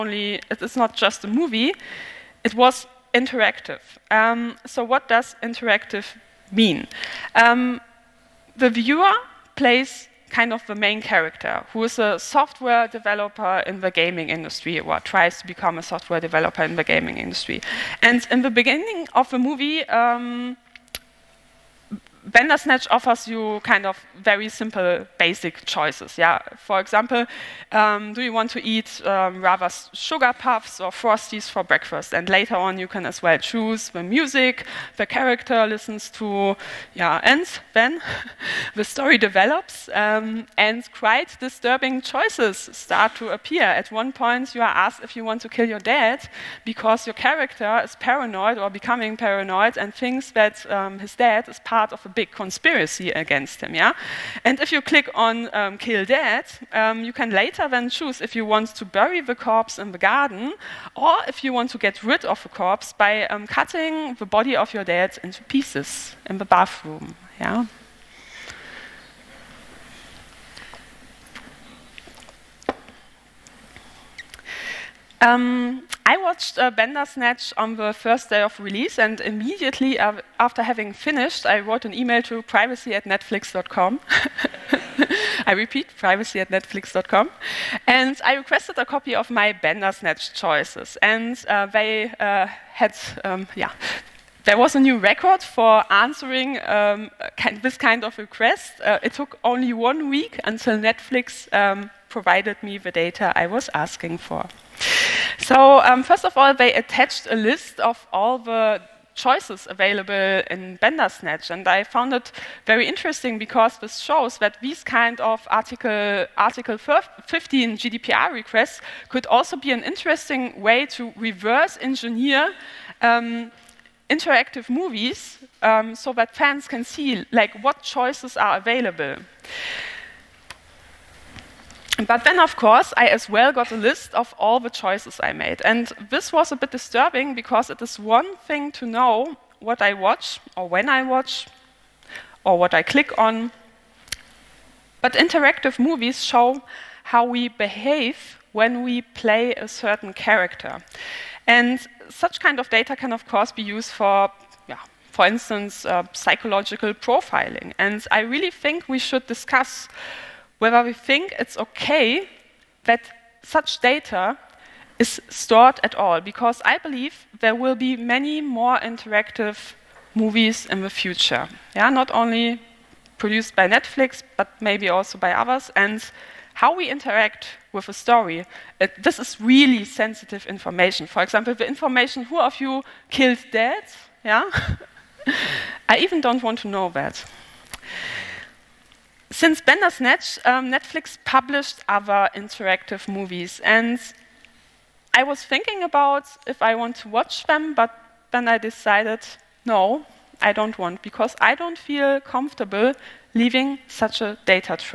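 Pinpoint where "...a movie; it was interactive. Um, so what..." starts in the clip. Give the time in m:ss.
0:01.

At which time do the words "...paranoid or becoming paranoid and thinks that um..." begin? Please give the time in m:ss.
0:47.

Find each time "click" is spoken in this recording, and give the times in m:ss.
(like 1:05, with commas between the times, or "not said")
0:54, 2:22.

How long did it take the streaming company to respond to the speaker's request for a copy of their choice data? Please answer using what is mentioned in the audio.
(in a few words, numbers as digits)
1 week.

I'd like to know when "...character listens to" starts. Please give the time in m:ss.
0:35.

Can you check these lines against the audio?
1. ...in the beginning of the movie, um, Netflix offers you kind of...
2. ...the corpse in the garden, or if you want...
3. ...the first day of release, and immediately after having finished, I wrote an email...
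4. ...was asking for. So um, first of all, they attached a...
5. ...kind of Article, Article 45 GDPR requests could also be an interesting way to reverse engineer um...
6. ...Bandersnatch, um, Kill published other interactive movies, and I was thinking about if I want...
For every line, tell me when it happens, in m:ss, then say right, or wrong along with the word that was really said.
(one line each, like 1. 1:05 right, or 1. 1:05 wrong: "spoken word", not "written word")
1. 0:18 wrong: "Bandersnatch", not "Netflix"
2. 0:59 right
3. 1:17 right
4. 1:43 right
5. 1:54 wrong: "15", not "45"
6. 3:09 wrong: "Netflix", not "Kill".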